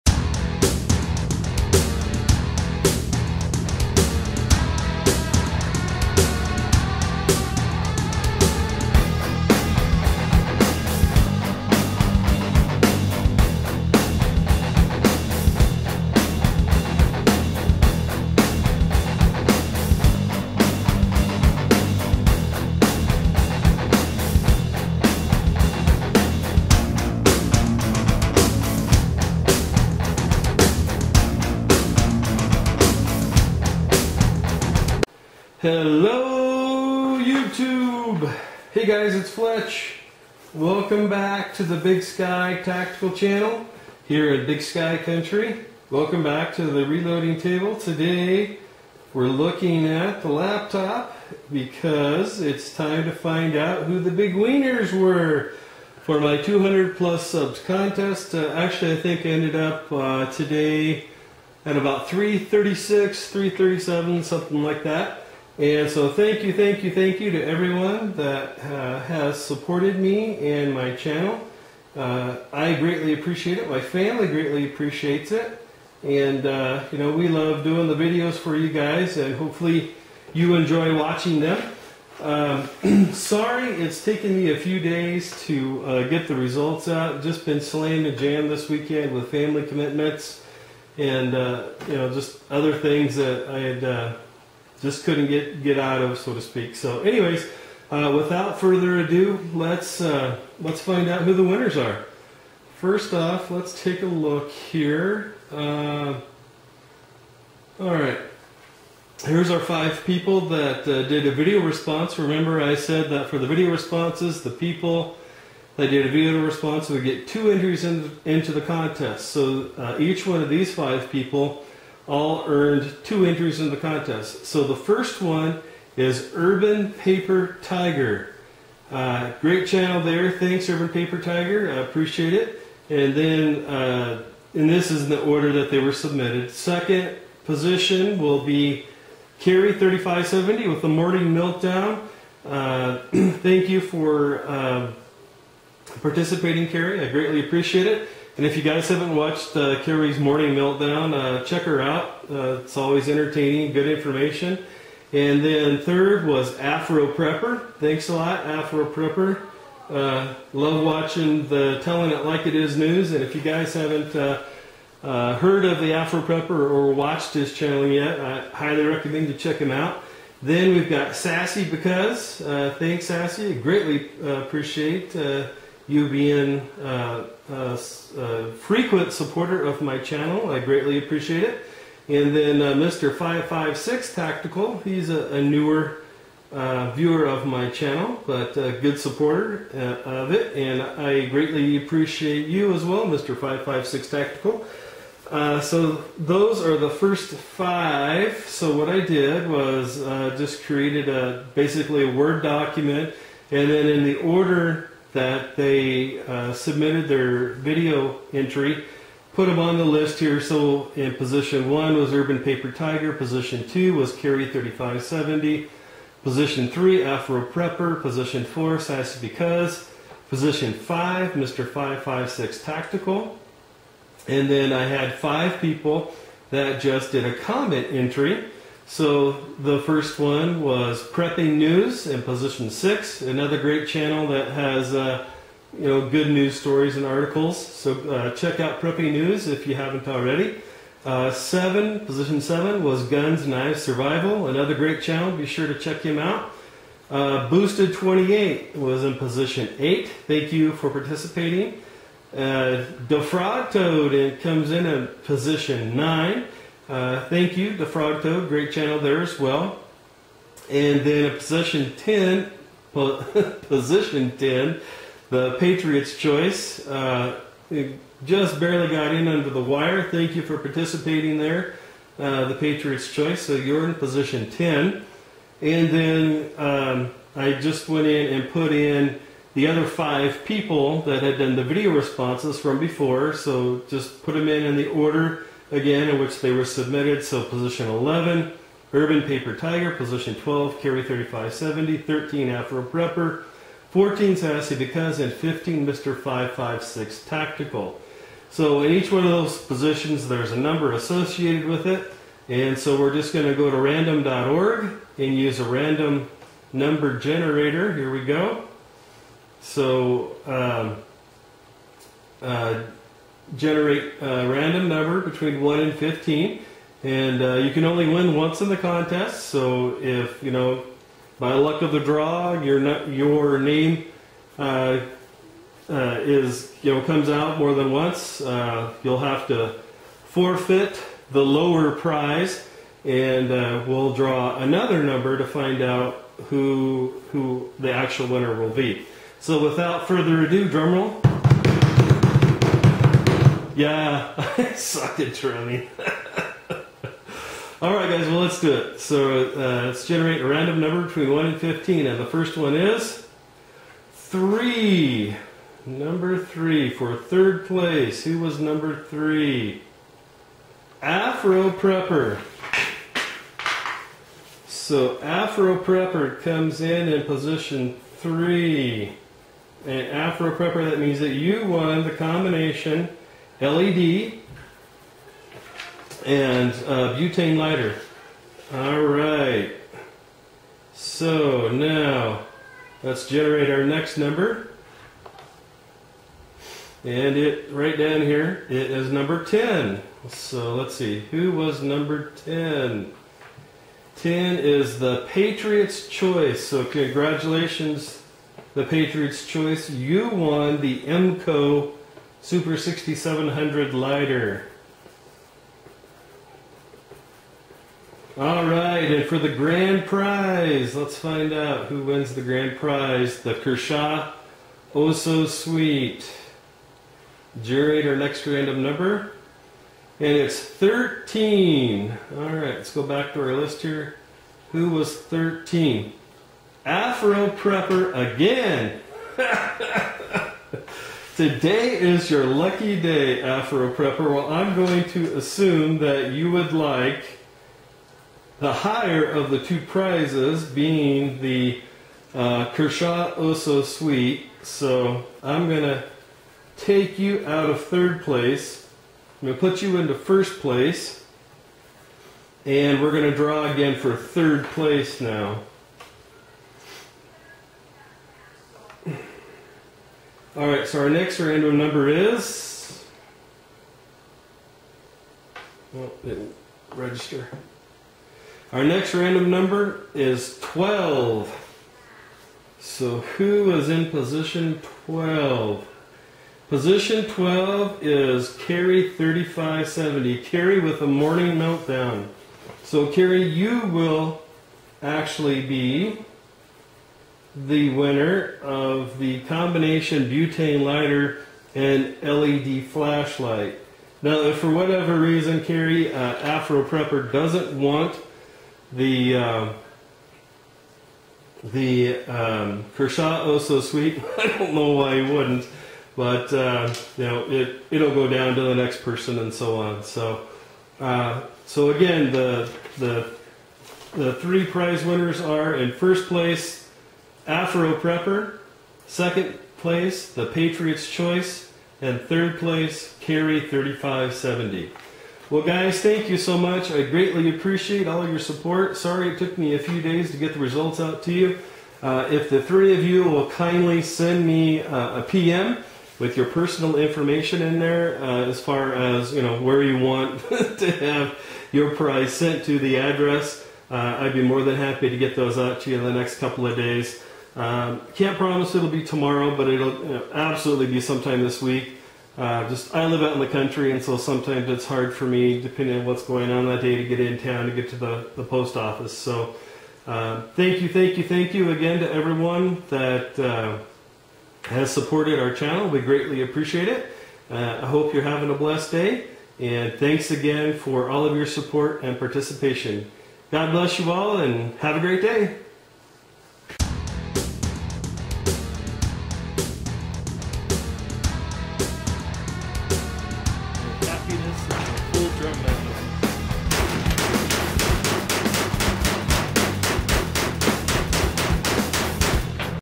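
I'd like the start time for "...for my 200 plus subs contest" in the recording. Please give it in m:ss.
0:56.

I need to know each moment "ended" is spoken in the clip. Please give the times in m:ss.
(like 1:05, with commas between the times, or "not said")
0:59.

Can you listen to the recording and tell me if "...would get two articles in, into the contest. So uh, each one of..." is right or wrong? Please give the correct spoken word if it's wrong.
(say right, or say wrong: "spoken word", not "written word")
wrong: "entries", not "articles".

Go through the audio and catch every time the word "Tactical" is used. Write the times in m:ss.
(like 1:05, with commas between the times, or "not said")
0:42, 3:04, 3:14, 3:42, 4:57.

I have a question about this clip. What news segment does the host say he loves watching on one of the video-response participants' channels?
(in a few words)
Telling It Like It Is.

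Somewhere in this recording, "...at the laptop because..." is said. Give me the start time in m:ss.
0:49.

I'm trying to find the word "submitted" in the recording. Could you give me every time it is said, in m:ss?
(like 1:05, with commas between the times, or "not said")
2:15, 3:26, 4:46.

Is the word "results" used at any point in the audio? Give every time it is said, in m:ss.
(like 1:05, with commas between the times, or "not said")
1:26, 8:50.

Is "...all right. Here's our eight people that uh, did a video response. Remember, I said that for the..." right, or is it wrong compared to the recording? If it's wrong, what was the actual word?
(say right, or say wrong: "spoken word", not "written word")
wrong: "five", not "eight".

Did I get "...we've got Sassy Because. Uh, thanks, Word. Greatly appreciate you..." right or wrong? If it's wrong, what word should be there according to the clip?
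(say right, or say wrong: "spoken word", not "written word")
wrong: "Sassy", not "Word".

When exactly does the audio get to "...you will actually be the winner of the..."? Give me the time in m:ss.
8:03.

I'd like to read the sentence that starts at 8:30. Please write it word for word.
So, uh, so again, the the the three prize winners are in first place Afro Prepper.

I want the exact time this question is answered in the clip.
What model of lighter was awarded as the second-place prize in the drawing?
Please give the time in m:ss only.
6:41.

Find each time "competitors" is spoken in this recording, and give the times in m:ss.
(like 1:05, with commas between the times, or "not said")
not said.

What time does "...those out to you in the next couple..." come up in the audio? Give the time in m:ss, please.
9:05.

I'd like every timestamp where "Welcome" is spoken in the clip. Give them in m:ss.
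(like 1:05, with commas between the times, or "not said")
0:40, 0:45.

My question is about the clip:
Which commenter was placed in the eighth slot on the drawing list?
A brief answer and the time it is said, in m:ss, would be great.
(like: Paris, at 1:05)
Boosted 28, at 4:07.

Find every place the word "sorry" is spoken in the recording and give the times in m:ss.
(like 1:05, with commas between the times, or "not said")
1:23, 8:48.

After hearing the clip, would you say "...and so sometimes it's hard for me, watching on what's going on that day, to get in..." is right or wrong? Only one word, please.
wrong.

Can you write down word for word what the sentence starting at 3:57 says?
So uh, check out Prepping News if you haven't already.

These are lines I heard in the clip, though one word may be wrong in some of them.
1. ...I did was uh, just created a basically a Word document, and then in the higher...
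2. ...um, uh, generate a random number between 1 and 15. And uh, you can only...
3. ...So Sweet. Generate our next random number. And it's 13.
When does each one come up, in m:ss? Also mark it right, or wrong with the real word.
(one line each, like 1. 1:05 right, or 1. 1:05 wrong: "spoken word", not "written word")
1. 3:18 wrong: "order", not "higher"
2. 5:10 right
3. 6:55 right.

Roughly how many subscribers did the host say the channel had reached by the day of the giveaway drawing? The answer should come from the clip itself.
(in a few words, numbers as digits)
336.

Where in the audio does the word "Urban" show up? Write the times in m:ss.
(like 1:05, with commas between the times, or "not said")
2:06, 2:10, 3:32, 4:48.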